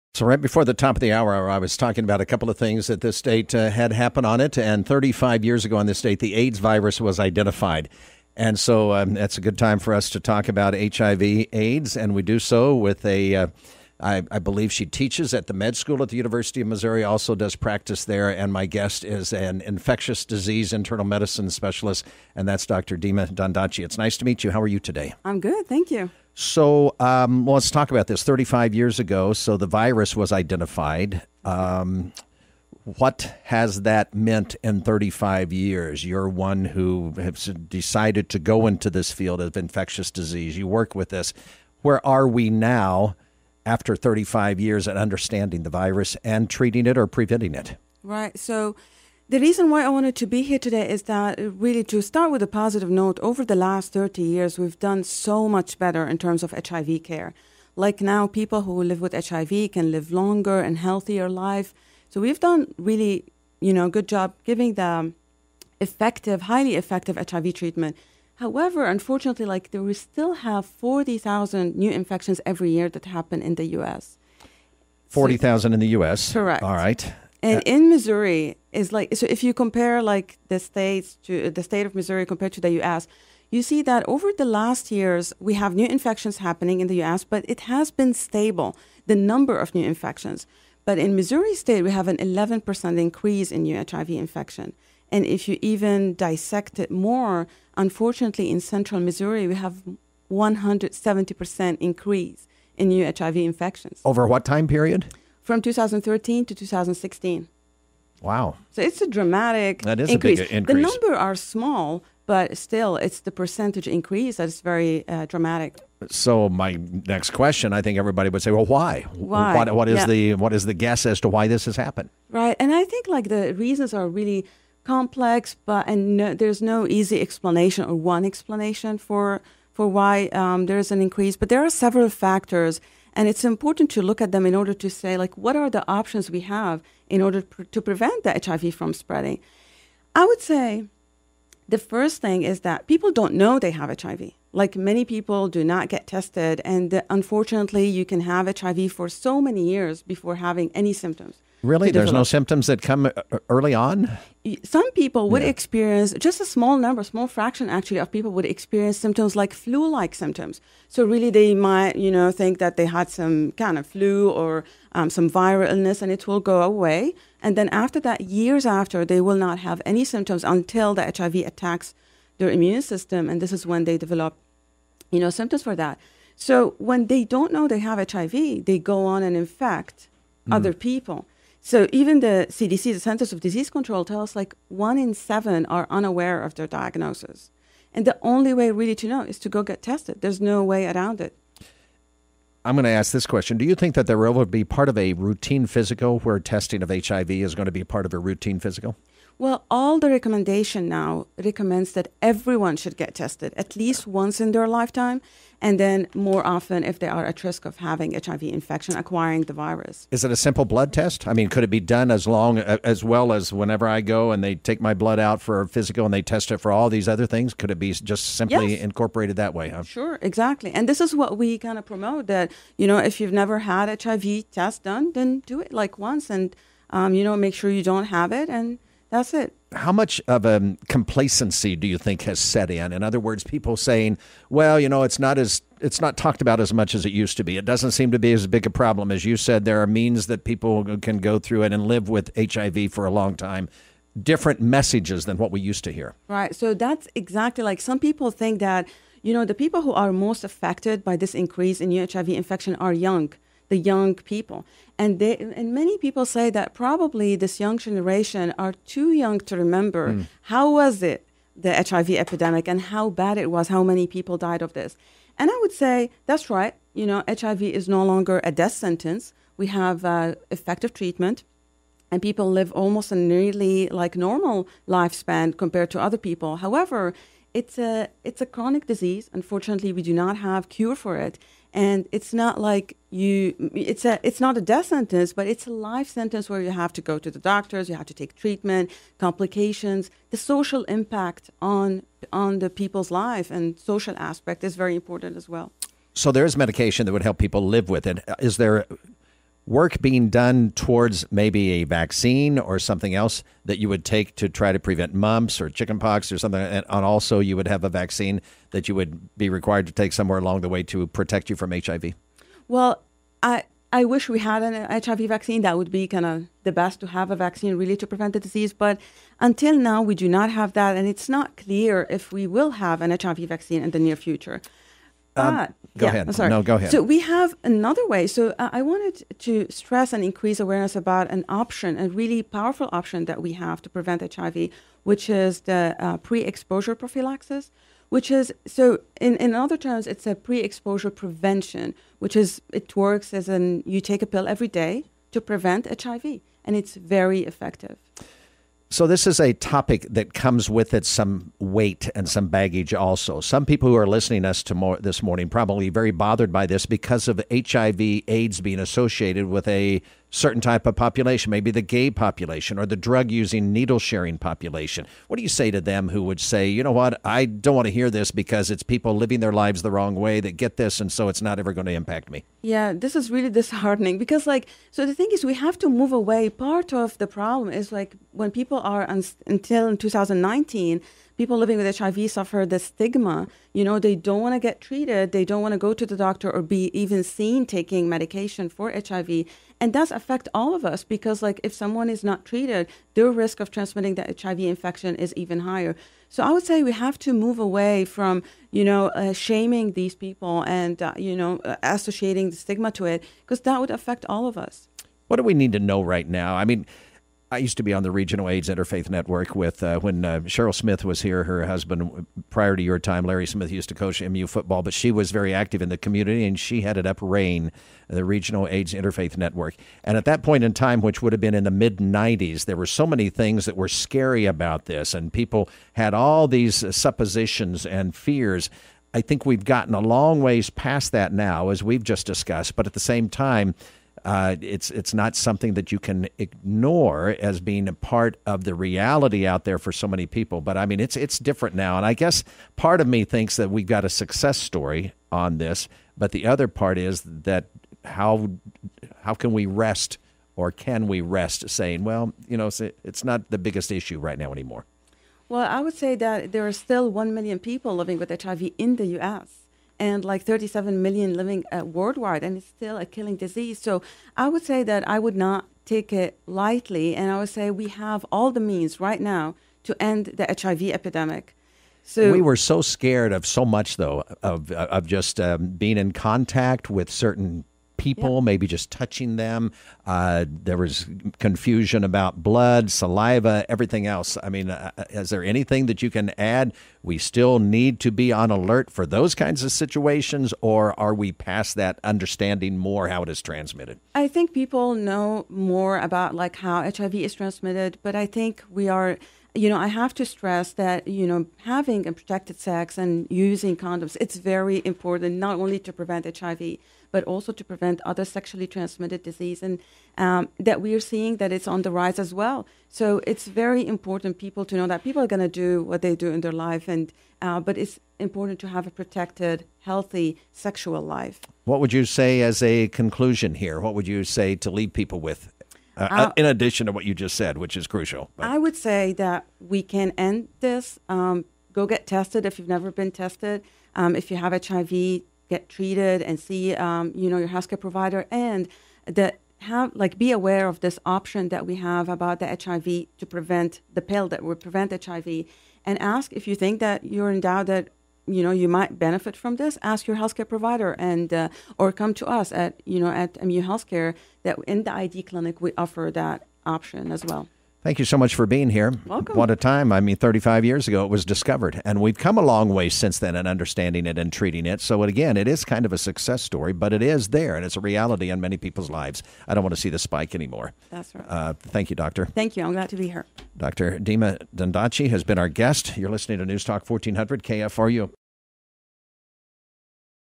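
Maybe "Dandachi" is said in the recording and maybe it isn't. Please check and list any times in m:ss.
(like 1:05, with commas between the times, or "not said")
0:23, 9:34.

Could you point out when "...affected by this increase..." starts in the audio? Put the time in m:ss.
4:10.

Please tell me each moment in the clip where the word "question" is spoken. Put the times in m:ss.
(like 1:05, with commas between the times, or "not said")
1:57, 3:13.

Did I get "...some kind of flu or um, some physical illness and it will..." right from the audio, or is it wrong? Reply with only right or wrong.
wrong.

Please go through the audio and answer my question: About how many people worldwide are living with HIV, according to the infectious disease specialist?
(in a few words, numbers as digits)
37 million.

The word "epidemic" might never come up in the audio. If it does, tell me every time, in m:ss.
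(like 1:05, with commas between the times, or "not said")
4:22, 7:50.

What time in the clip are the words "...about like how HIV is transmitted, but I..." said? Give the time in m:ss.
8:15.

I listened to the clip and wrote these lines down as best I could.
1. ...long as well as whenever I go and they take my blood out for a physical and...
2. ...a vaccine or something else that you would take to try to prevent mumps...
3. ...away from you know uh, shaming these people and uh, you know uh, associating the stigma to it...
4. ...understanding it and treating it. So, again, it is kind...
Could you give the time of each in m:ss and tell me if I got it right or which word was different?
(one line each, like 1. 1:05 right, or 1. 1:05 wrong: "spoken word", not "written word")
1. 3:32 right
2. 5:01 right
3. 6:37 right
4. 9:23 right.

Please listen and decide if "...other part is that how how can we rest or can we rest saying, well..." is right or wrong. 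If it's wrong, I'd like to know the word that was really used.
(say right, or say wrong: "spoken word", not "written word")
right.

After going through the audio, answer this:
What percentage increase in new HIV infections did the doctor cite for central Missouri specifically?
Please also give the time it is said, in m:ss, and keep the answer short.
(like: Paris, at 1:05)
170%, at 1:40.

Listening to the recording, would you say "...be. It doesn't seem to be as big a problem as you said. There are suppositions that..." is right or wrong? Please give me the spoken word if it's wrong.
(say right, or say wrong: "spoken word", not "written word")
wrong: "means", not "suppositions".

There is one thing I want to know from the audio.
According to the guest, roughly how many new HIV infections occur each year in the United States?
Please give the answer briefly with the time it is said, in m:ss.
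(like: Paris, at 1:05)
40,000, at 1:10.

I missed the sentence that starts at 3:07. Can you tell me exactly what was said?
And the only way really to know is to go get tested.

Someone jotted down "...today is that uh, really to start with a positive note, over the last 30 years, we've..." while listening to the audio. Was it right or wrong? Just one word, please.
right.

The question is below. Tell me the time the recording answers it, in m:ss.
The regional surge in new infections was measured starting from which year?
1:45.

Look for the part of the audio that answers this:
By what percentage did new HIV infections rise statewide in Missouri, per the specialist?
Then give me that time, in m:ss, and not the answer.
1:32.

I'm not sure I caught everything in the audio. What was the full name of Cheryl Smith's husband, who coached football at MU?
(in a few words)
Larry Smith.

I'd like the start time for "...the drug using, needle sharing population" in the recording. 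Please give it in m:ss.
6:02.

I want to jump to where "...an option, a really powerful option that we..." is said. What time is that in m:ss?
5:31.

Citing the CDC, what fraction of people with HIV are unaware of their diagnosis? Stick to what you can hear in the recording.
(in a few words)
One in seven.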